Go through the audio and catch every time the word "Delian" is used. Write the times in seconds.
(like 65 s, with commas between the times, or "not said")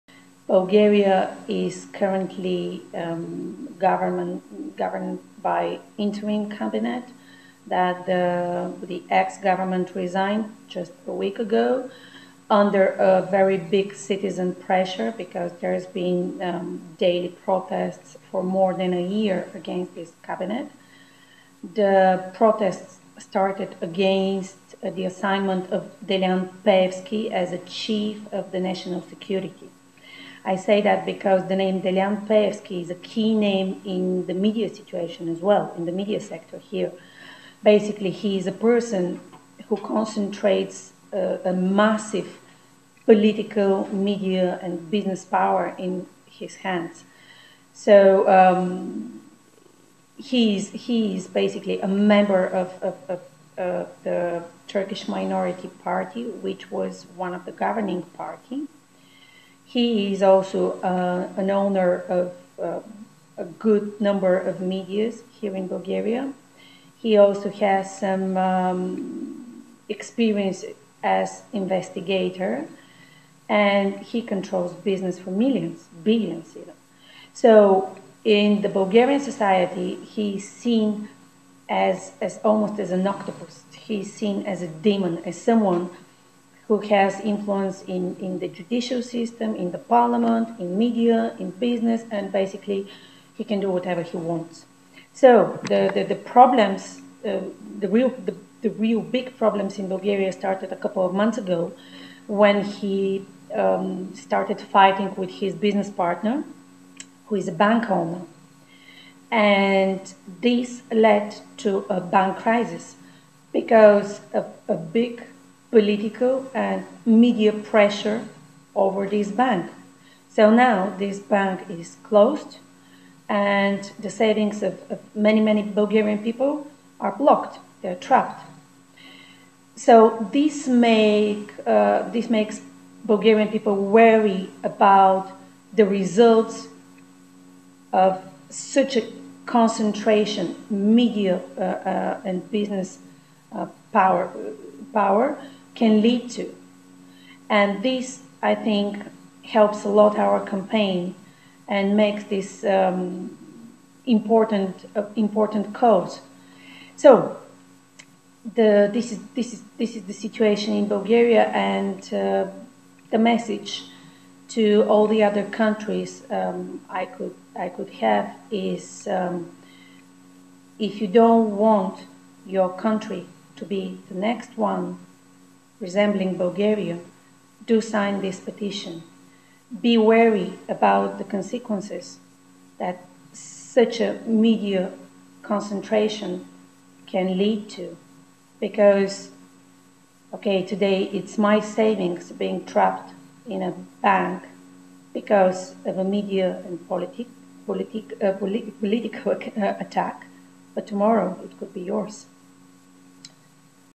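26 s, 31 s.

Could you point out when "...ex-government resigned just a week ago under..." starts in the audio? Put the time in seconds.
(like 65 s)
9 s.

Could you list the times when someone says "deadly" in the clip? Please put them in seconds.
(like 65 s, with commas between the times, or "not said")
not said.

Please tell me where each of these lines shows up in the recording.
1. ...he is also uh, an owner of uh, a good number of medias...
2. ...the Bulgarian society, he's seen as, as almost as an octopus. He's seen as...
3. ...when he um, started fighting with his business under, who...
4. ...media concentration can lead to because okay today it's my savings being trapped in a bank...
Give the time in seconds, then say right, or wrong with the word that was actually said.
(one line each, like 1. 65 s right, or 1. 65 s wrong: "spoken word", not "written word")
1. 59 s right
2. 78 s right
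3. 102 s wrong: "partner", not "under"
4. 184 s right.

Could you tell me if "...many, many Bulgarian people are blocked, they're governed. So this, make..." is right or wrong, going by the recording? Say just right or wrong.
wrong.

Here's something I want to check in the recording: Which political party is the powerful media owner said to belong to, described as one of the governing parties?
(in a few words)
Turkish Minority Party.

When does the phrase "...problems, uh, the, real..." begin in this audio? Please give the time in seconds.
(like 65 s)
96 s.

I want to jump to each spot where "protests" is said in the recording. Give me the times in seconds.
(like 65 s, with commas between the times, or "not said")
17 s, 22 s.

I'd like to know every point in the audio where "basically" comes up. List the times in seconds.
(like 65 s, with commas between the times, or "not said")
37 s, 51 s, 92 s.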